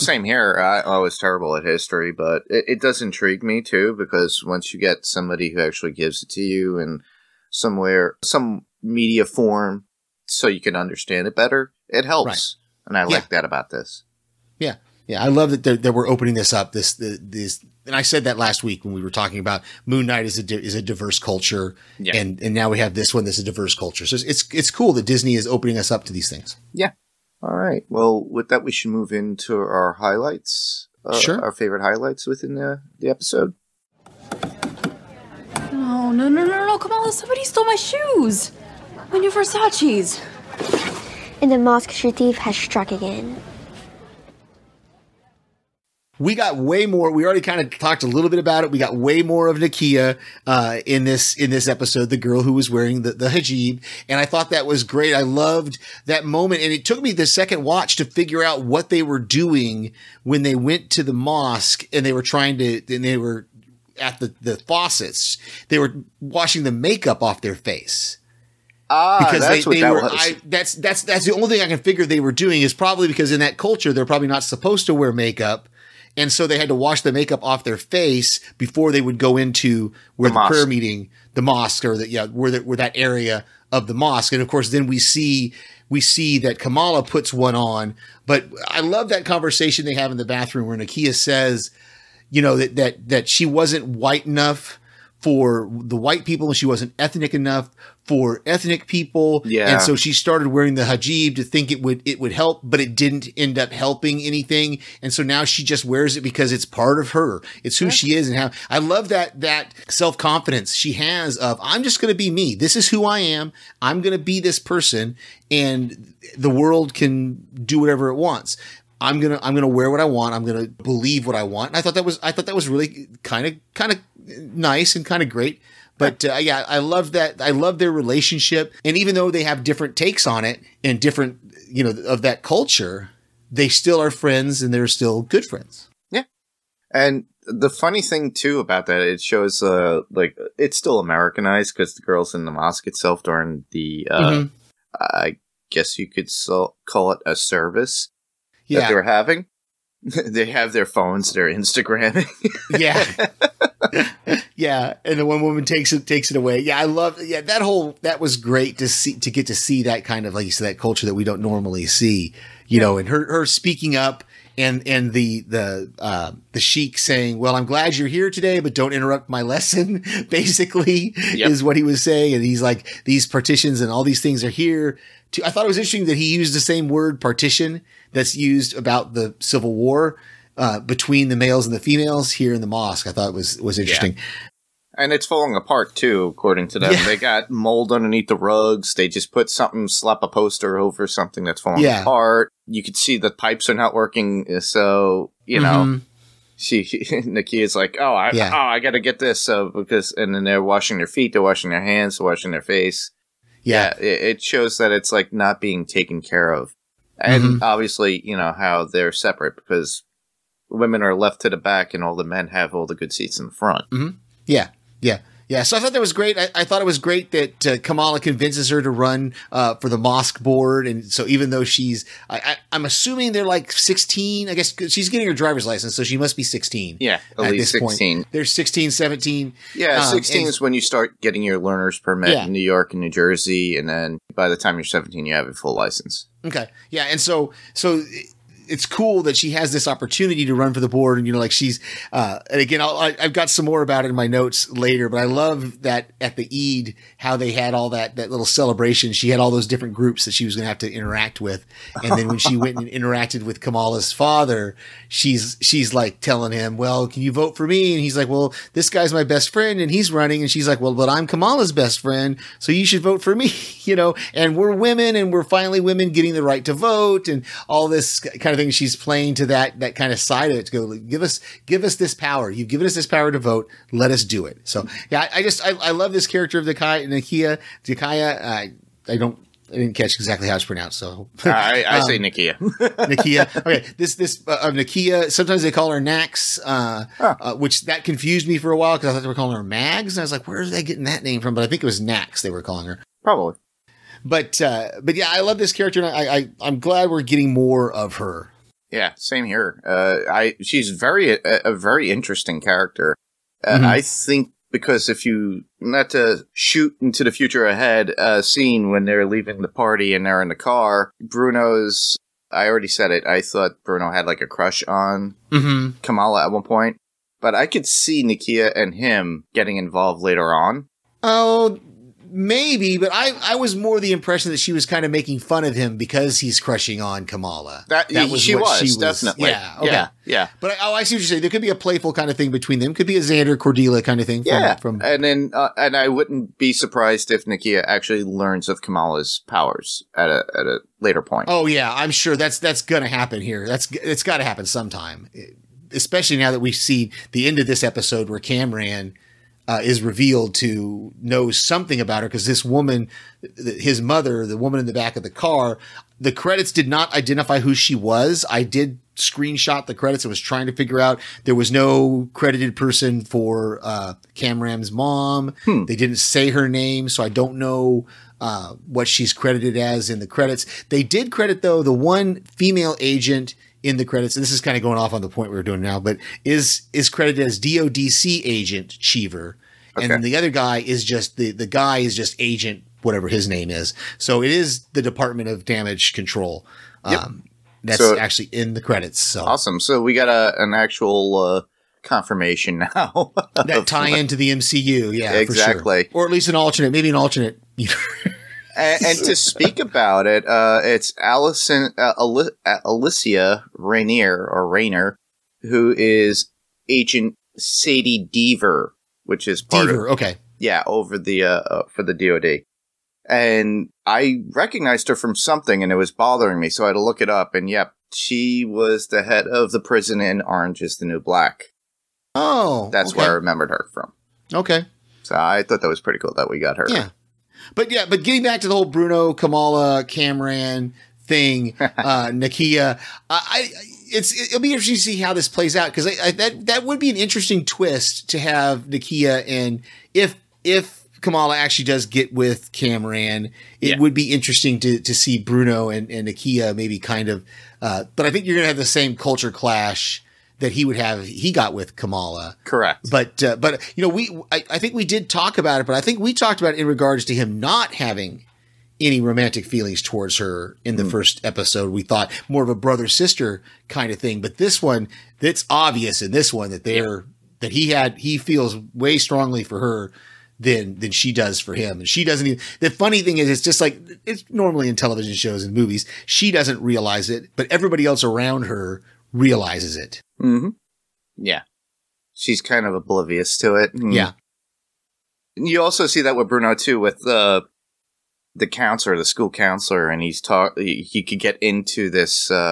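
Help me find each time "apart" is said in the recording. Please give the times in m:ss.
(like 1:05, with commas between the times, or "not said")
3:05, 3:12.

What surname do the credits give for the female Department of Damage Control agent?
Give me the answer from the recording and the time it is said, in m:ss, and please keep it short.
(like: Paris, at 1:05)
Cheever, at 6:18.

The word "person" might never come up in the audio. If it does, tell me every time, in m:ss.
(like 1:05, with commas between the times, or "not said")
1:54, 6:02.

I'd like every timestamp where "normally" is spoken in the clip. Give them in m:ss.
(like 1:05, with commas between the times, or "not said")
2:41, 7:54.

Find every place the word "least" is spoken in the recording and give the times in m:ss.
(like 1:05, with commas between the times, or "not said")
3:47, 6:36.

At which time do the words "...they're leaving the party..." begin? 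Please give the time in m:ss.
5:09.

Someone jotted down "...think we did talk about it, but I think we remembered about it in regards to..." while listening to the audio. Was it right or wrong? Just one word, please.
wrong.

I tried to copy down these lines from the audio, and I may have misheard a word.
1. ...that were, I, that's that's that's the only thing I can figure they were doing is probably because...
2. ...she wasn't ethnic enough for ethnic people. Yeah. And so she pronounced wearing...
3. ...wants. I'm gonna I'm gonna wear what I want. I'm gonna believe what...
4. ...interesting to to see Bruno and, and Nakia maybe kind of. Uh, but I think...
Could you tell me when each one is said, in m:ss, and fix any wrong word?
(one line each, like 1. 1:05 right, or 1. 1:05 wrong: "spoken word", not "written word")
1. 1:09 right
2. 1:36 wrong: "started", not "pronounced"
3. 1:58 right
4. 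7:24 right.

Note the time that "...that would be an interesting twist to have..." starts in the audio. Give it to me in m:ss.
7:16.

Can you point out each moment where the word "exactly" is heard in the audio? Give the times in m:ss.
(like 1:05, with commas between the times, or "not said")
4:40, 6:35.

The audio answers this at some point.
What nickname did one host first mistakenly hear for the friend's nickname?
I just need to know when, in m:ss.
4:49.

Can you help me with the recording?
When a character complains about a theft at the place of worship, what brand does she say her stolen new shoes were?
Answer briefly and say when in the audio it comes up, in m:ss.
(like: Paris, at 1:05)
Versace, at 0:39.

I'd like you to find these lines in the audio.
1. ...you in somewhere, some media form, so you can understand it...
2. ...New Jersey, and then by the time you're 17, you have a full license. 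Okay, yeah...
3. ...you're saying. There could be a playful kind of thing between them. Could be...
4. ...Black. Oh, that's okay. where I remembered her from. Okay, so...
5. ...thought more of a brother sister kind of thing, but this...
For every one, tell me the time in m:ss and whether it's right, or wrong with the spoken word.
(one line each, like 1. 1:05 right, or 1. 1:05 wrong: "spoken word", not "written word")
1. 0:06 right
2. 3:53 right
3. 5:31 right
4. 7:01 right
5. 7:42 right.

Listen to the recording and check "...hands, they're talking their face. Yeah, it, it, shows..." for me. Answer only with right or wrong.
wrong.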